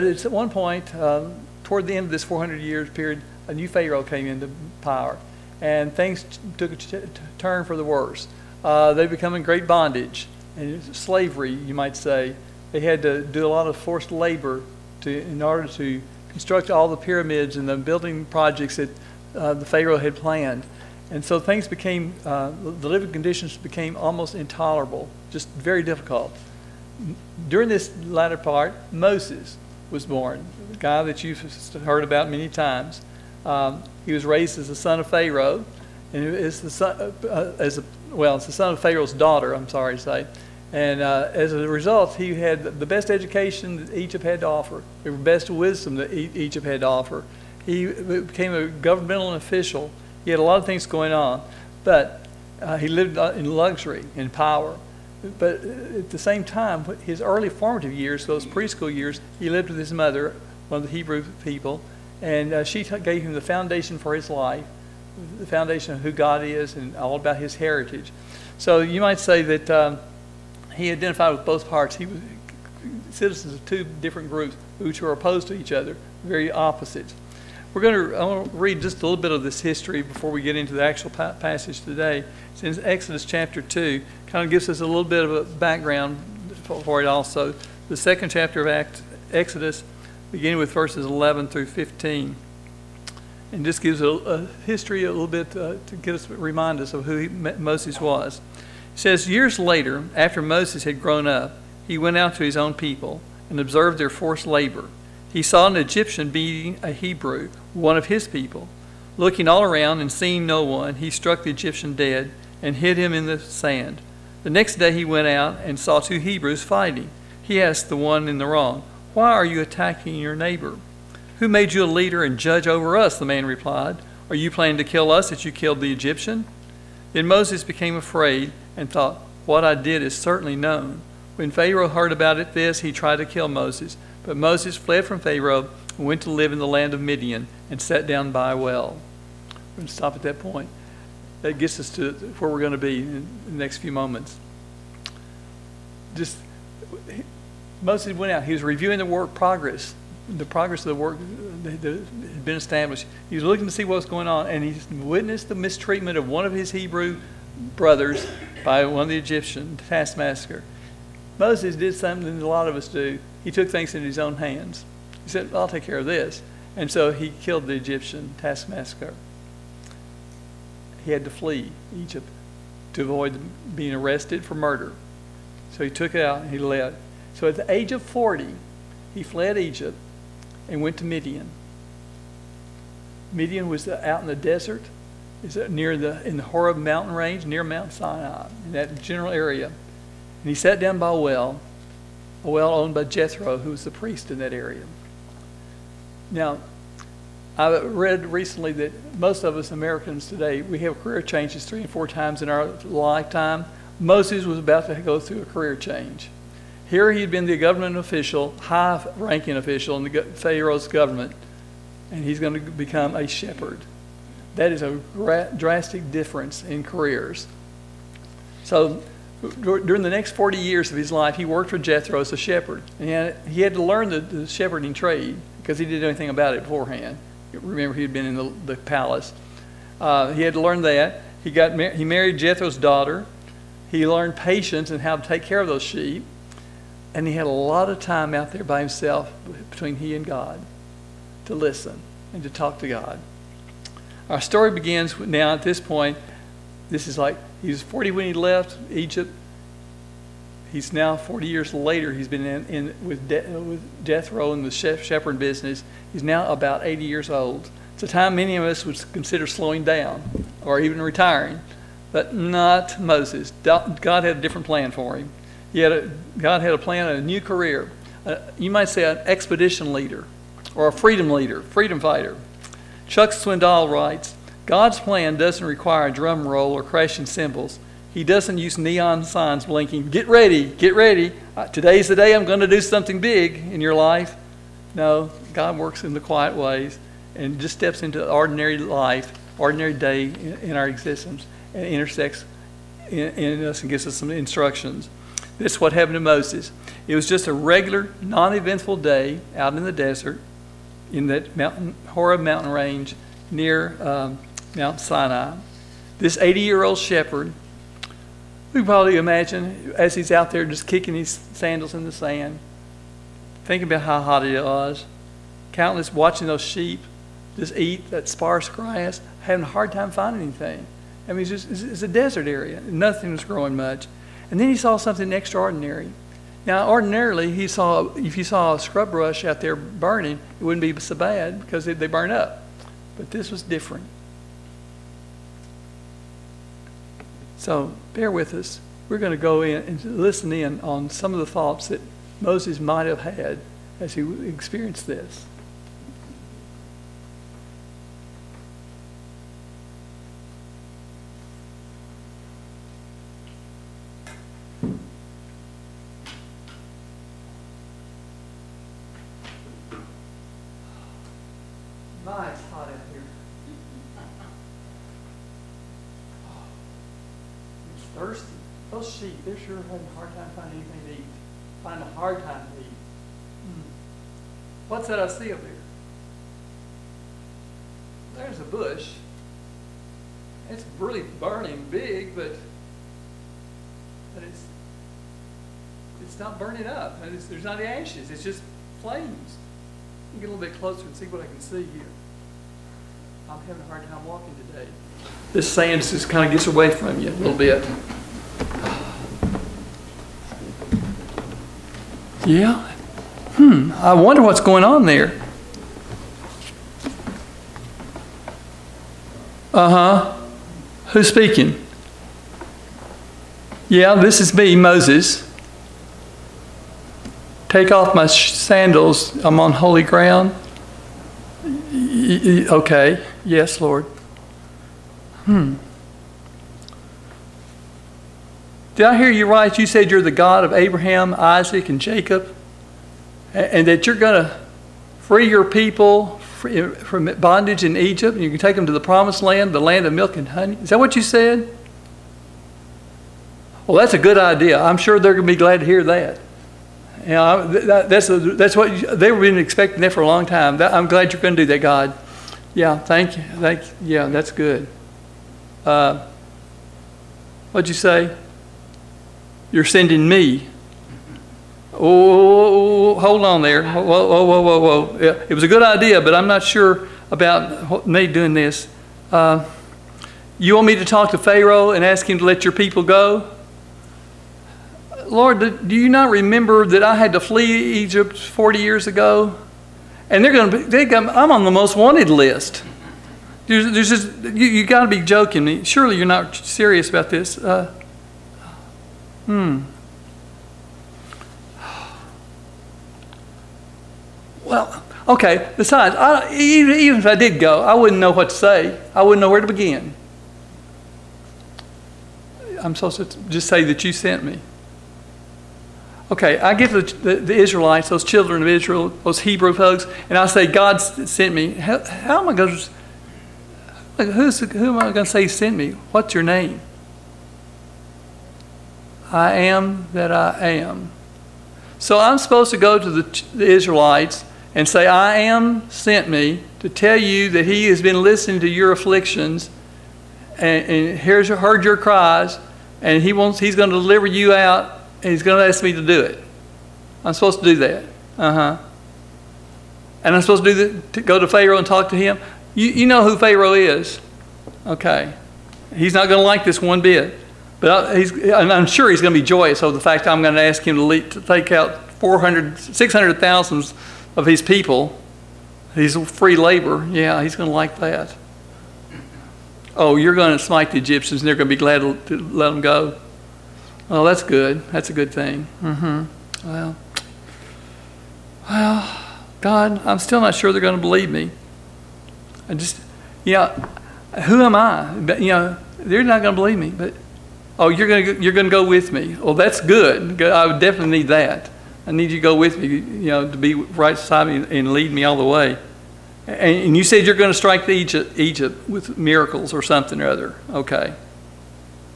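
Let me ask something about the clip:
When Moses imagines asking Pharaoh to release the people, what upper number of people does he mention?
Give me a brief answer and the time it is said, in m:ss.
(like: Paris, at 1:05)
600,000, at 9:12.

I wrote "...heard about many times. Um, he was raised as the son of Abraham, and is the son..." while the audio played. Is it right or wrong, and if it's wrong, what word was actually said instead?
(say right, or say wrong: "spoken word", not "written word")
wrong: "Pharaoh", not "Abraham".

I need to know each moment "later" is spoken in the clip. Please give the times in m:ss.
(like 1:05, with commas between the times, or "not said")
1:39, 4:11.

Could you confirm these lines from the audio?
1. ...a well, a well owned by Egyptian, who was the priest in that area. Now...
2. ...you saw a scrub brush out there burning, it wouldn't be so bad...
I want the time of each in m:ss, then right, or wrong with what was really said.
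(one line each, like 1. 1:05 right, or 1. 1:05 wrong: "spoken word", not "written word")
1. 3:11 wrong: "Jethro", not "Egyptian"
2. 5:28 right.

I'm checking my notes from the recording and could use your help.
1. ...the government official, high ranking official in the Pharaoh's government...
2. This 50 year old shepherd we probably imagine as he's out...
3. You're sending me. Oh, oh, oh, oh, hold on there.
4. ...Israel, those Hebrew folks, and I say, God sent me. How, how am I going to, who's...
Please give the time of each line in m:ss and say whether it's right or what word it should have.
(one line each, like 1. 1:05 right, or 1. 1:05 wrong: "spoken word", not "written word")
1. 3:27 right
2. 5:06 wrong: "80", not "50"
3. 7:39 right
4. 8:28 right.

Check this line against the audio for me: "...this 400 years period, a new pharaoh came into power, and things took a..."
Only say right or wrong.
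right.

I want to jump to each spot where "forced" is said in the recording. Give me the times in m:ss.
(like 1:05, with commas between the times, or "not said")
0:13, 1:44.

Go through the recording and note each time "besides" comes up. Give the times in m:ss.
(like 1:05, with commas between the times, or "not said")
8:15, 9:44.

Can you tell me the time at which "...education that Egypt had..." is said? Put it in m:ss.
0:43.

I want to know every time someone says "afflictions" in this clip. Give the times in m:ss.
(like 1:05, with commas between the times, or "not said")
8:48.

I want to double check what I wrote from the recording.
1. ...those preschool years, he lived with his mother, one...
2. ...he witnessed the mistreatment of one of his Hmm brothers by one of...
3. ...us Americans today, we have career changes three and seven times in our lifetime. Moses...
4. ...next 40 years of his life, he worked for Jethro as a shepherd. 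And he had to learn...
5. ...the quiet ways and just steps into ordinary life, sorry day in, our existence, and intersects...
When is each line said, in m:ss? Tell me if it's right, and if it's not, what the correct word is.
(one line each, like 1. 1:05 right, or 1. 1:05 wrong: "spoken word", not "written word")
1. 0:58 right
2. 2:34 wrong: "Hebrew", not "Hmm"
3. 3:19 wrong: "four", not "seven"
4. 3:40 right
5. 4:46 wrong: "ordinary", not "sorry".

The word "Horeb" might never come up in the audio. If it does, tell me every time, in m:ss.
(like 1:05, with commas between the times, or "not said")
3:06, 5:02.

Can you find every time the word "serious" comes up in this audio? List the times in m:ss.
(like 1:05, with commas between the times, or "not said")
8:06.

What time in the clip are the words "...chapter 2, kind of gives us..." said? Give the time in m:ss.
1:23.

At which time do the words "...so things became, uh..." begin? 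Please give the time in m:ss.
0:21.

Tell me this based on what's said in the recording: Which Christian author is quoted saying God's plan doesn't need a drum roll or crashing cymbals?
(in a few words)
Chuck Swindoll.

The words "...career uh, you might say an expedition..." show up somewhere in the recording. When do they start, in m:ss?
4:27.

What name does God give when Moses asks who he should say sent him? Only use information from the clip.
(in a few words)
I am that I am.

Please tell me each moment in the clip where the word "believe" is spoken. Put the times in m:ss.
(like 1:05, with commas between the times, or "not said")
9:31, 9:36.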